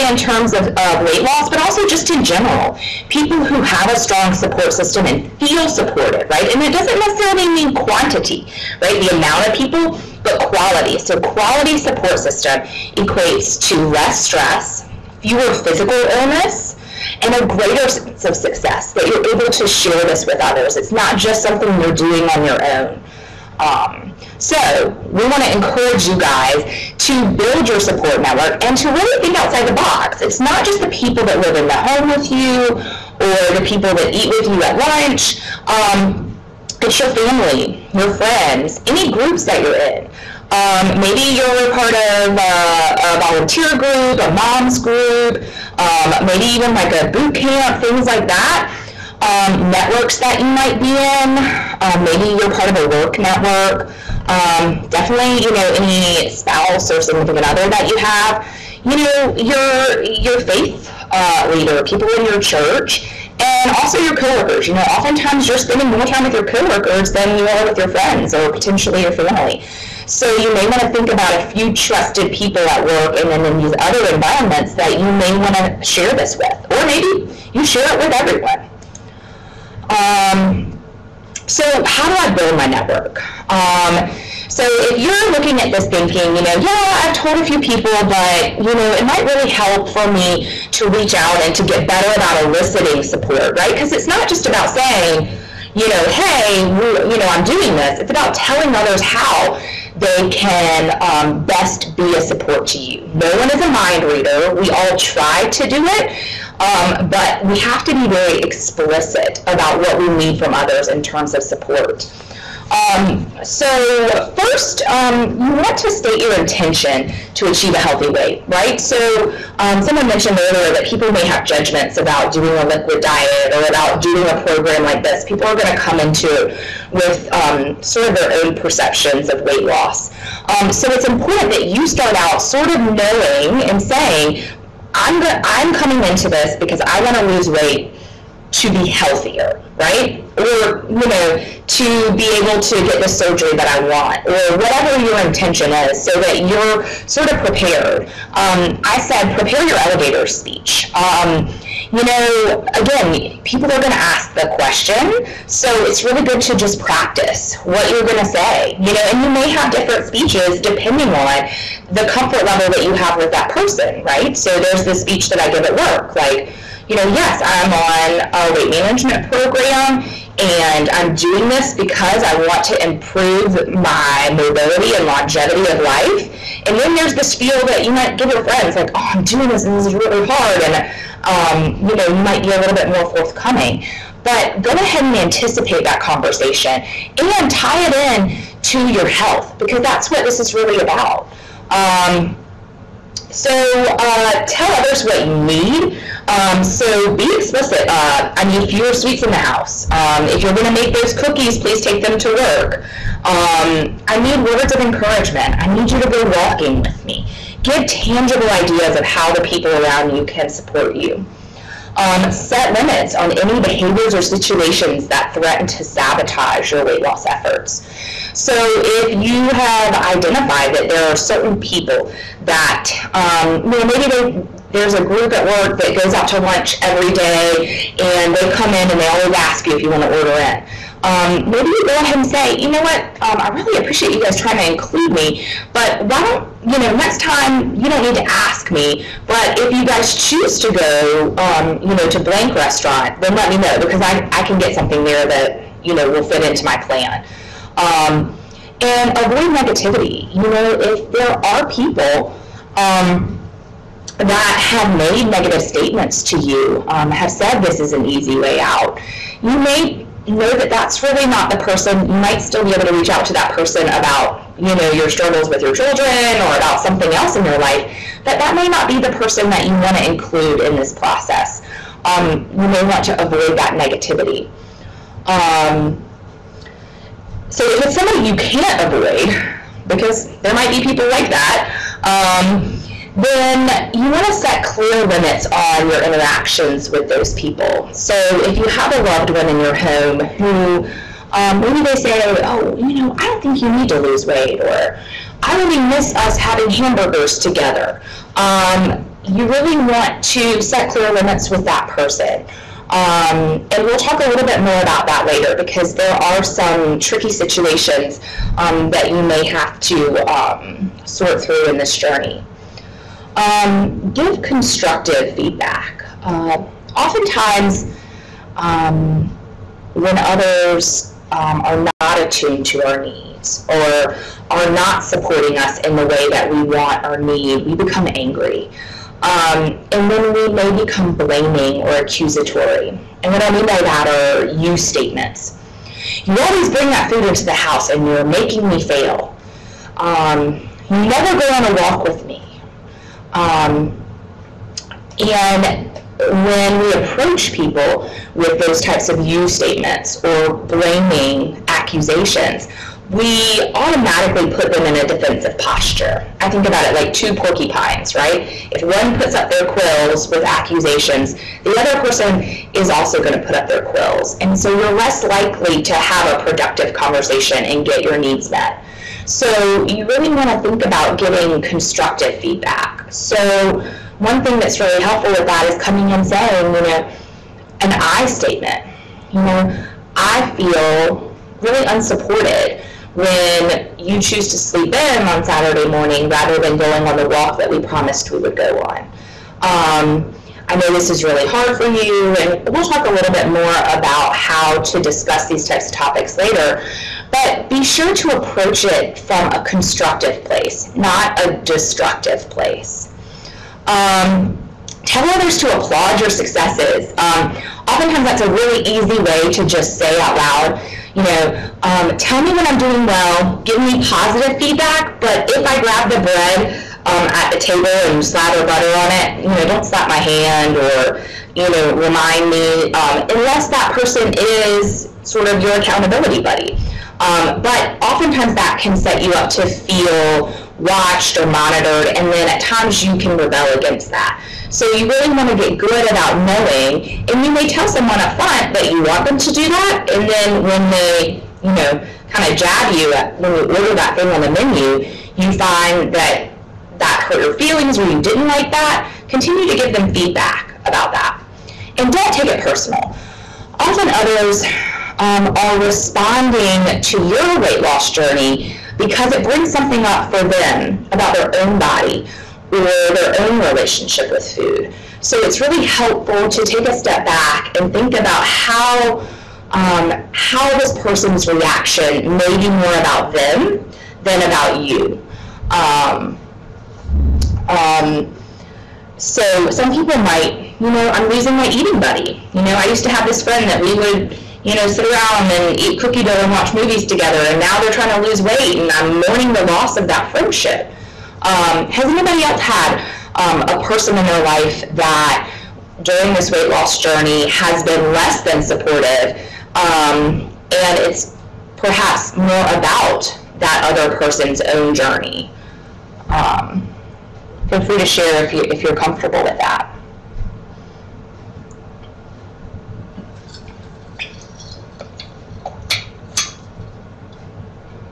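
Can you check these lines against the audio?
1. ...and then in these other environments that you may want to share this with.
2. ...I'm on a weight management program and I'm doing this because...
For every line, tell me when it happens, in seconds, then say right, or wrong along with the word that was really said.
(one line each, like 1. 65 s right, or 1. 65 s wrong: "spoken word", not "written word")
1. 73 s right
2. 167 s right.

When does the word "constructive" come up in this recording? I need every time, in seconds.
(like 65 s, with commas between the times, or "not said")
314 s, 371 s, 399 s.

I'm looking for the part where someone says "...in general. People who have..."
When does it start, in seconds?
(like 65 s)
2 s.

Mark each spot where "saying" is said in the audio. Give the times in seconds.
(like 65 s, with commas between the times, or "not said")
94 s, 133 s, 376 s.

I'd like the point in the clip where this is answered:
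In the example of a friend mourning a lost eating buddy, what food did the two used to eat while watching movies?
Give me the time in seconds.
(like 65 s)
485 s.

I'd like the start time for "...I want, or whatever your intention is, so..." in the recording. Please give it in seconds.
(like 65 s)
143 s.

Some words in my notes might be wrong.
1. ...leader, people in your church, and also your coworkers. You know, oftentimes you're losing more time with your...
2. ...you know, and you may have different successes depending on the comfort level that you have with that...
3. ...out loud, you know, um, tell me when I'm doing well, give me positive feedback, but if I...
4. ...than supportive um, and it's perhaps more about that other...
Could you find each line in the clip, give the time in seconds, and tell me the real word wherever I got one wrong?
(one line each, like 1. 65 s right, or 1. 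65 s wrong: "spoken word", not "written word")
1. 61 s wrong: "spending", not "losing"
2. 158 s wrong: "speeches", not "successes"
3. 410 s right
4. 498 s right.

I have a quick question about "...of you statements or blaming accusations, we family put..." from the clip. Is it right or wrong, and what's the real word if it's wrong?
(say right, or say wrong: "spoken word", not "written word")
wrong: "automatically", not "family".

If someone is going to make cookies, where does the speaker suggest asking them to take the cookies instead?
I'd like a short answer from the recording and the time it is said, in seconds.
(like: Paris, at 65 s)
to work, at 201 s.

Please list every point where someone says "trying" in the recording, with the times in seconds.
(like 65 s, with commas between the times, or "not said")
234 s, 487 s.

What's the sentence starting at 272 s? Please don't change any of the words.
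Um, you may want to avoid that negativity.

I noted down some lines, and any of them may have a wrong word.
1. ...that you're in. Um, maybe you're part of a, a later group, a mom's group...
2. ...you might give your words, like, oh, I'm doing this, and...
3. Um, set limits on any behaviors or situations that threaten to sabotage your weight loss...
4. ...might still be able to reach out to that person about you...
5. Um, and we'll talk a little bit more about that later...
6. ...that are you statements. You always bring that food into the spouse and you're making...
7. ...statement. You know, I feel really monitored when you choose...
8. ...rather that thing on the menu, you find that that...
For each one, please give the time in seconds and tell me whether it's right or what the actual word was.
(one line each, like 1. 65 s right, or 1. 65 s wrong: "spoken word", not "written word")
1. 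39 s wrong: "volunteer", not "later"
2. 177 s wrong: "friends", not "words"
3. 211 s right
4. 262 s right
5. 302 s right
6. 333 s wrong: "house", not "spouse"
7. 378 s wrong: "unsupported", not "monitored"
8. 443 s wrong: "order", not "rather".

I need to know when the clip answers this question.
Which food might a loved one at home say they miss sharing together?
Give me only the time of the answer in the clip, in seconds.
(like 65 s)
296 s.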